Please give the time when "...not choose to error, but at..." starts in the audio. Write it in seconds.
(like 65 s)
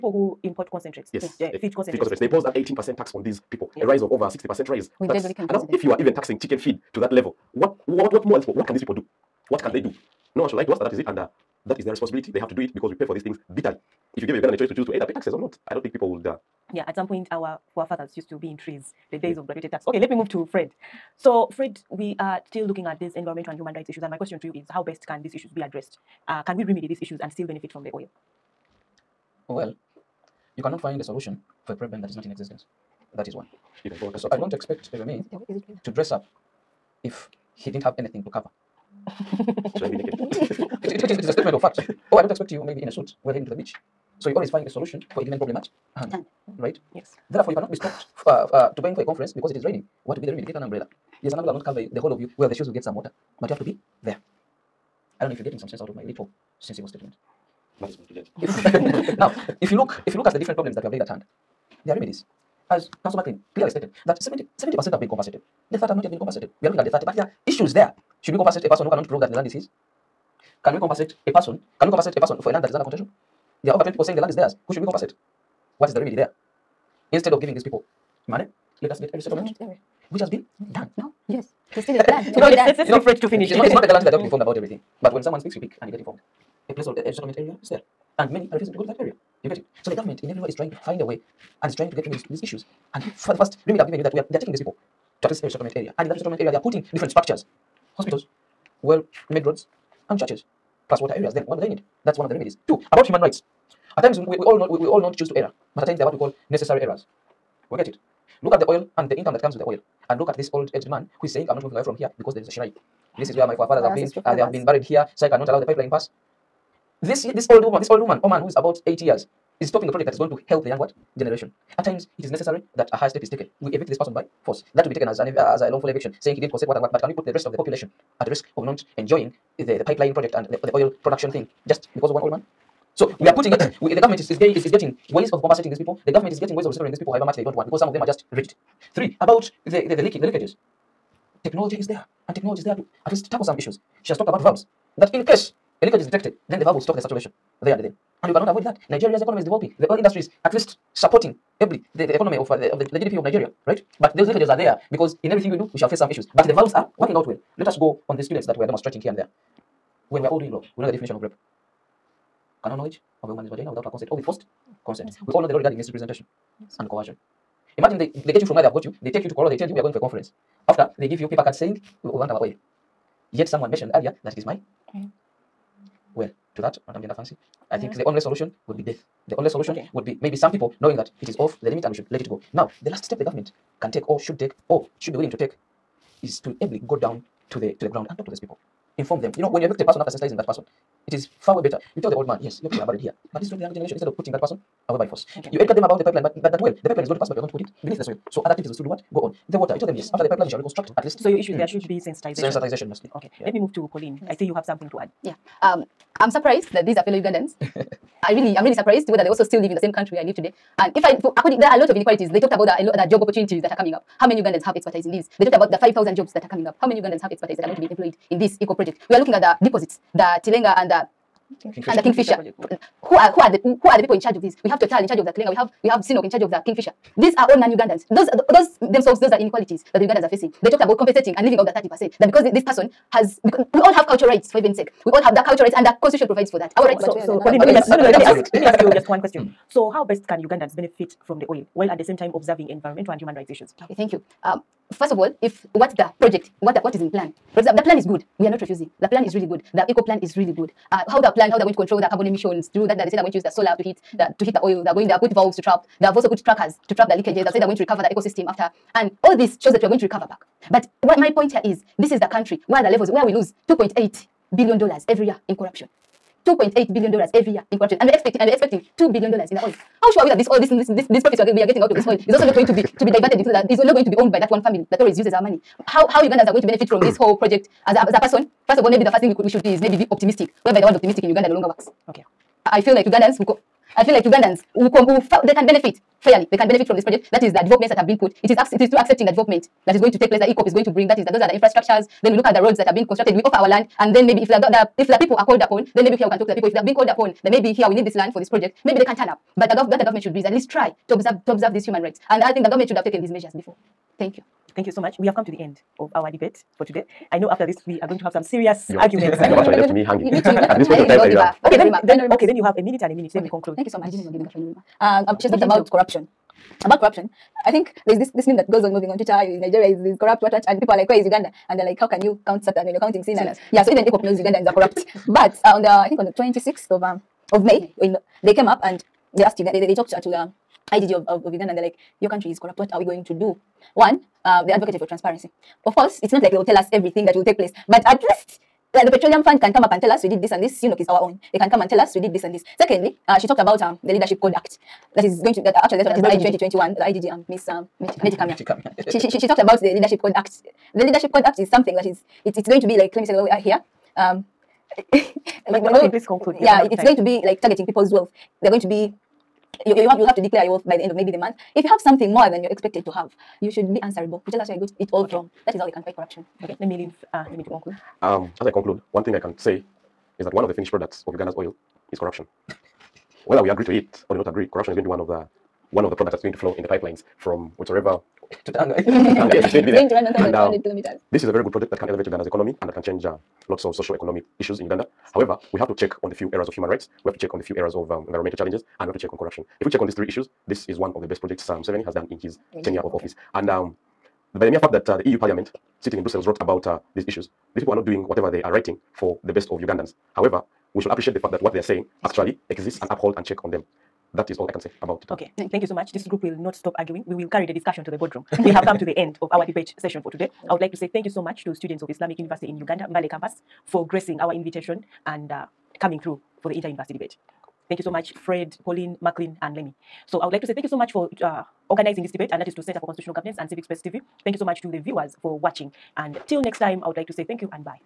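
105 s.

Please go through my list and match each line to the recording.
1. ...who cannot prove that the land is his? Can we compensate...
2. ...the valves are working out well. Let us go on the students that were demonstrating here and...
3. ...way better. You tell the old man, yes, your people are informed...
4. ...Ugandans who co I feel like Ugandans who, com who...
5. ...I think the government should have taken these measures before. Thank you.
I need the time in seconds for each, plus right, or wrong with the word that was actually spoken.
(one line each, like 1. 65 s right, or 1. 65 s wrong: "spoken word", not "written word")
1. 68 s right
2. 156 s right
3. 191 s wrong: "buried", not "informed"
4. 283 s right
5. 302 s right.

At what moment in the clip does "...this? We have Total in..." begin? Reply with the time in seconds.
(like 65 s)
224 s.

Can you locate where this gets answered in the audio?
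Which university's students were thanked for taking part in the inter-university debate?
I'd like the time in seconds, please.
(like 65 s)
412 s.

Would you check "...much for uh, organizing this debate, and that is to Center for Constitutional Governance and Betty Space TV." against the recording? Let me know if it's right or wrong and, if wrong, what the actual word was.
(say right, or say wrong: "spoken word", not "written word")
wrong: "Civic", not "Betty".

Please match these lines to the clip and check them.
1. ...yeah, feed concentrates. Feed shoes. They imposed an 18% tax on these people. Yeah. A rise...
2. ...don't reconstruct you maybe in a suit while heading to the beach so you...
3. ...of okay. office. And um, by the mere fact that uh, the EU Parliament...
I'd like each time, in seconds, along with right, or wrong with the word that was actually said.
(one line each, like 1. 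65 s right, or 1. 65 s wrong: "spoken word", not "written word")
1. 1 s wrong: "concentrates", not "shoes"
2. 42 s wrong: "expect", not "reconstruct"
3. 392 s right.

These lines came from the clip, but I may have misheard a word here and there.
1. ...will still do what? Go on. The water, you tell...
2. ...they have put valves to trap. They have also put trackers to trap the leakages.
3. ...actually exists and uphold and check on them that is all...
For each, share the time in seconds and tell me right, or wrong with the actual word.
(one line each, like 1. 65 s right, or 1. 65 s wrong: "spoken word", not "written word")
1. 198 s right
2. 255 s right
3. 402 s right.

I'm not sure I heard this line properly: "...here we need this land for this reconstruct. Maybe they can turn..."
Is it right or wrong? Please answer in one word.
wrong.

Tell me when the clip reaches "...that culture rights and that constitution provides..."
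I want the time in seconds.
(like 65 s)
235 s.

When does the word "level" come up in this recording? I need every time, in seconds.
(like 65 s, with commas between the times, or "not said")
7 s, 262 s.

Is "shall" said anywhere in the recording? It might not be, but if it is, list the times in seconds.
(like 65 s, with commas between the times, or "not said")
155 s, 200 s.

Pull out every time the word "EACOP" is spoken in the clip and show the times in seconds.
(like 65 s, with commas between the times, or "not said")
218 s, 249 s, 290 s, 324 s.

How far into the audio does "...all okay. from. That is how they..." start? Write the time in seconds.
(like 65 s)
365 s.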